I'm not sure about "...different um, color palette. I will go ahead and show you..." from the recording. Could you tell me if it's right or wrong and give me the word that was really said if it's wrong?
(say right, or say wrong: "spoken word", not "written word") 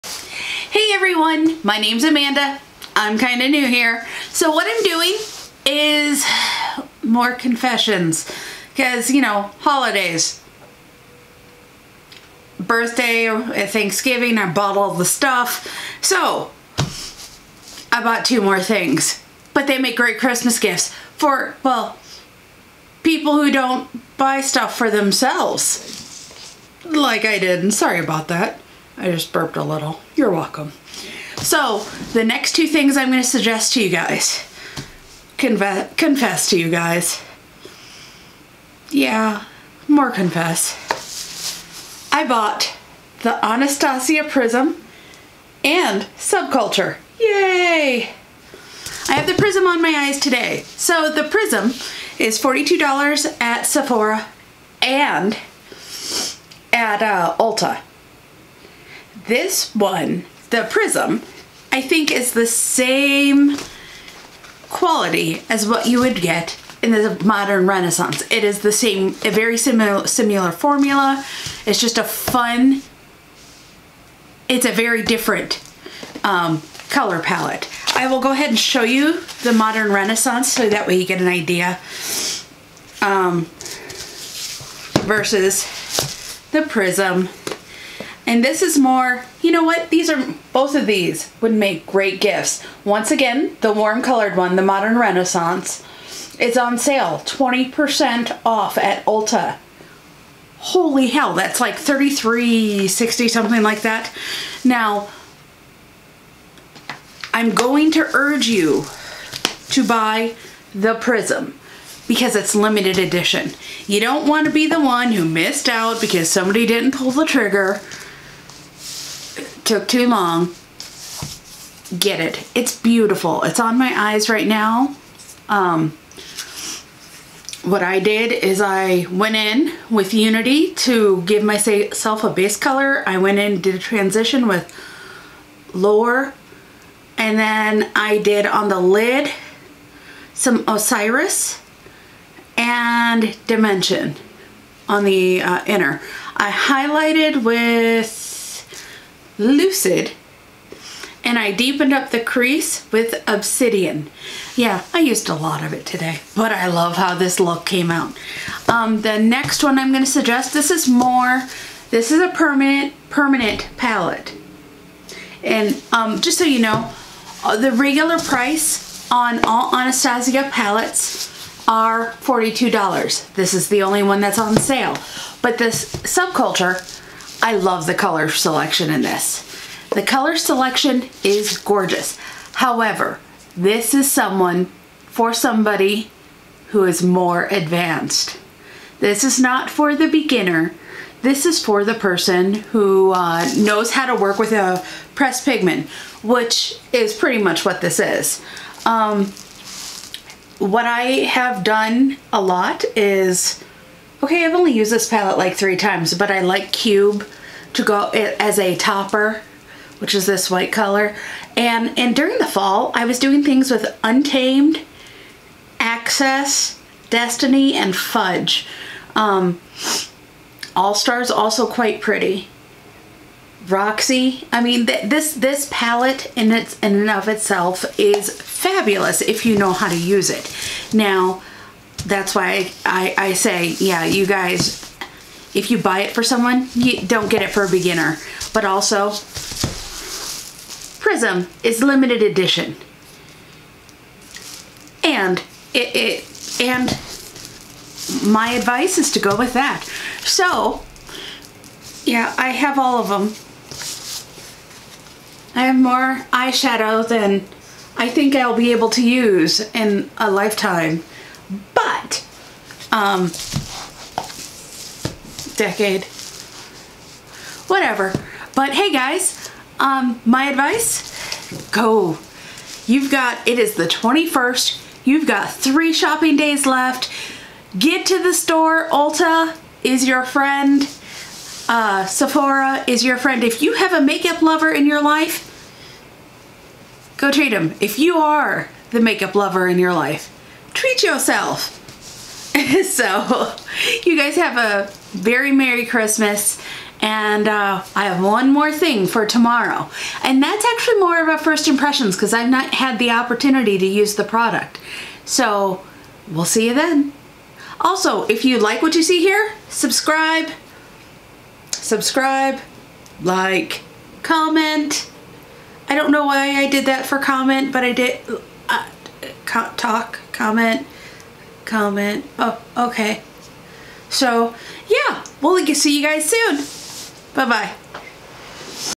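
right.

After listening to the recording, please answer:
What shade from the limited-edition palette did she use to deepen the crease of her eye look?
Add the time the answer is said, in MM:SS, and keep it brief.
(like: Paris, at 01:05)
Obsidian, at 02:33.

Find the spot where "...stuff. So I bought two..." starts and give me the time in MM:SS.
00:15.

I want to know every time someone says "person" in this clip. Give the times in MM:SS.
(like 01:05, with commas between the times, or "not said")
03:11.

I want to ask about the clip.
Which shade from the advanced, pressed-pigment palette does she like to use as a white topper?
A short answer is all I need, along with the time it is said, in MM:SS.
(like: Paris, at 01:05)
Cube, at 03:26.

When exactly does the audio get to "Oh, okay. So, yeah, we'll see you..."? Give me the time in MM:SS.
05:22.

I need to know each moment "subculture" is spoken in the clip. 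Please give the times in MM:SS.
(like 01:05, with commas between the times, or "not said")
00:46, 02:55.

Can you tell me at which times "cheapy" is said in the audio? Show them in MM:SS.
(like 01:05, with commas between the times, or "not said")
not said.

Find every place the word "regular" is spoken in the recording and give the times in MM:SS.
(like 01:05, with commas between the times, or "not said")
02:47.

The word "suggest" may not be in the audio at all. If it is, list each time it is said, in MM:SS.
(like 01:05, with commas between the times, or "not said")
00:33, 02:40.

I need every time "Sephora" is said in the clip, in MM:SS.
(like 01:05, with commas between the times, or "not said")
00:53, 04:42.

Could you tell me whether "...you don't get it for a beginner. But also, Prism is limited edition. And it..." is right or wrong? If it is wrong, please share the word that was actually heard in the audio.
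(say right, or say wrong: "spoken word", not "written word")
right.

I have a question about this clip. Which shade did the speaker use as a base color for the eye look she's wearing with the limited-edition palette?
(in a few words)
Unity.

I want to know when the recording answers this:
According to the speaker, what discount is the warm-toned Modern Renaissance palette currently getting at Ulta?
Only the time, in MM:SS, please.
01:37.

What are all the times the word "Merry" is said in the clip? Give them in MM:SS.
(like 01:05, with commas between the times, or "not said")
04:55.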